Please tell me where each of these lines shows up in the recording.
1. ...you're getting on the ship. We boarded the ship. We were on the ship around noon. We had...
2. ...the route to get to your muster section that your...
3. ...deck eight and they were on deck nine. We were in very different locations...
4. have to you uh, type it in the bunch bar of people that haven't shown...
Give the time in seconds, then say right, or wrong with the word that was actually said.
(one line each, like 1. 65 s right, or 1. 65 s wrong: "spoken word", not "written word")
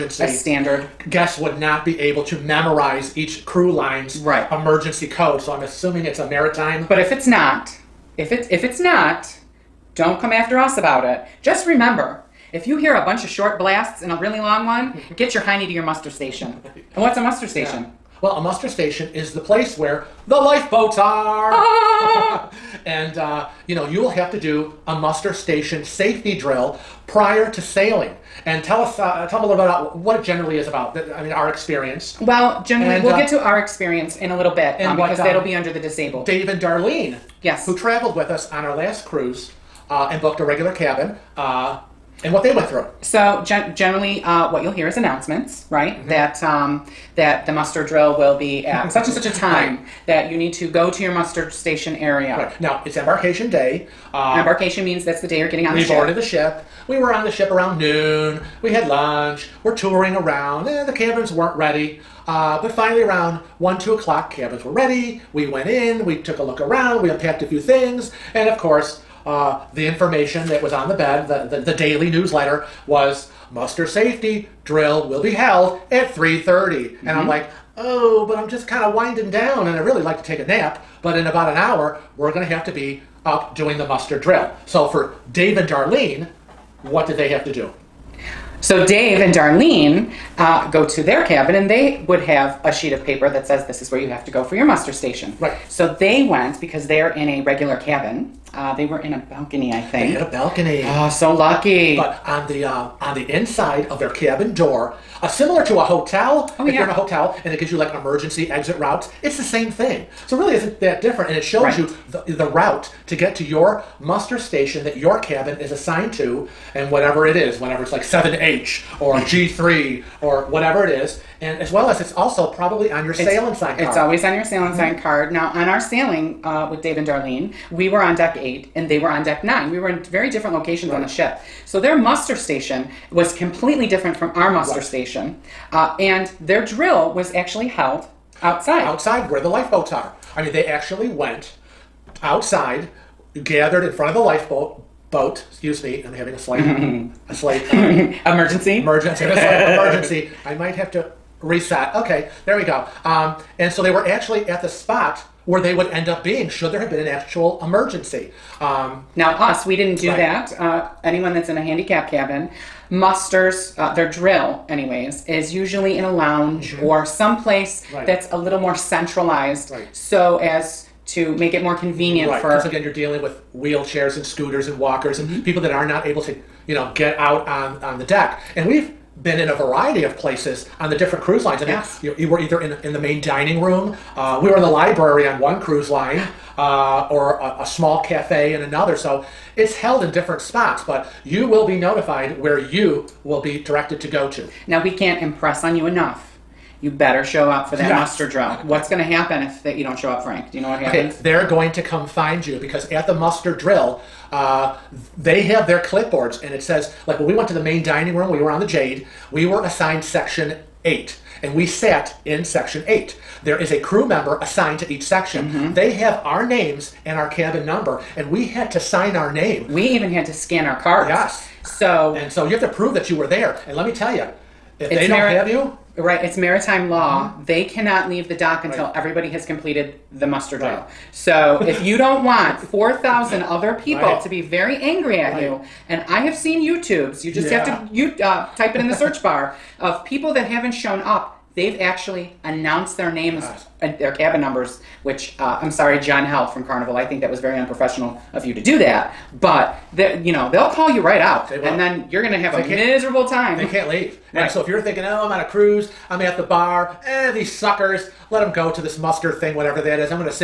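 1. 55 s right
2. 112 s wrong: "station", not "section"
3. 128 s right
4. 237 s wrong: "search", not "bunch".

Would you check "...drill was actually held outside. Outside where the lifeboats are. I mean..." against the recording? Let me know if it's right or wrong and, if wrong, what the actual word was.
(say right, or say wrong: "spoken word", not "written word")
right.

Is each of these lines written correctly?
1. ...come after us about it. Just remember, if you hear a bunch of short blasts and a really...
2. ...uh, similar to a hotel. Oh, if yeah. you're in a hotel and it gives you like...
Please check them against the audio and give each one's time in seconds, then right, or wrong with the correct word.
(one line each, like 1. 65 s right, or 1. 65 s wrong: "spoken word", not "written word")
1. 10 s right
2. 105 s right.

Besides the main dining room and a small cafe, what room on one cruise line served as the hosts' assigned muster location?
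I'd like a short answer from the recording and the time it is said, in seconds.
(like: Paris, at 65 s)
The library, at 184 s.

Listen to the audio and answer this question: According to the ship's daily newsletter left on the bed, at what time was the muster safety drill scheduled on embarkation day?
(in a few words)
3:30.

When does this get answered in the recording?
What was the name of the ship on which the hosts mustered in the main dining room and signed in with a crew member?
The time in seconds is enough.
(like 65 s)
208 s.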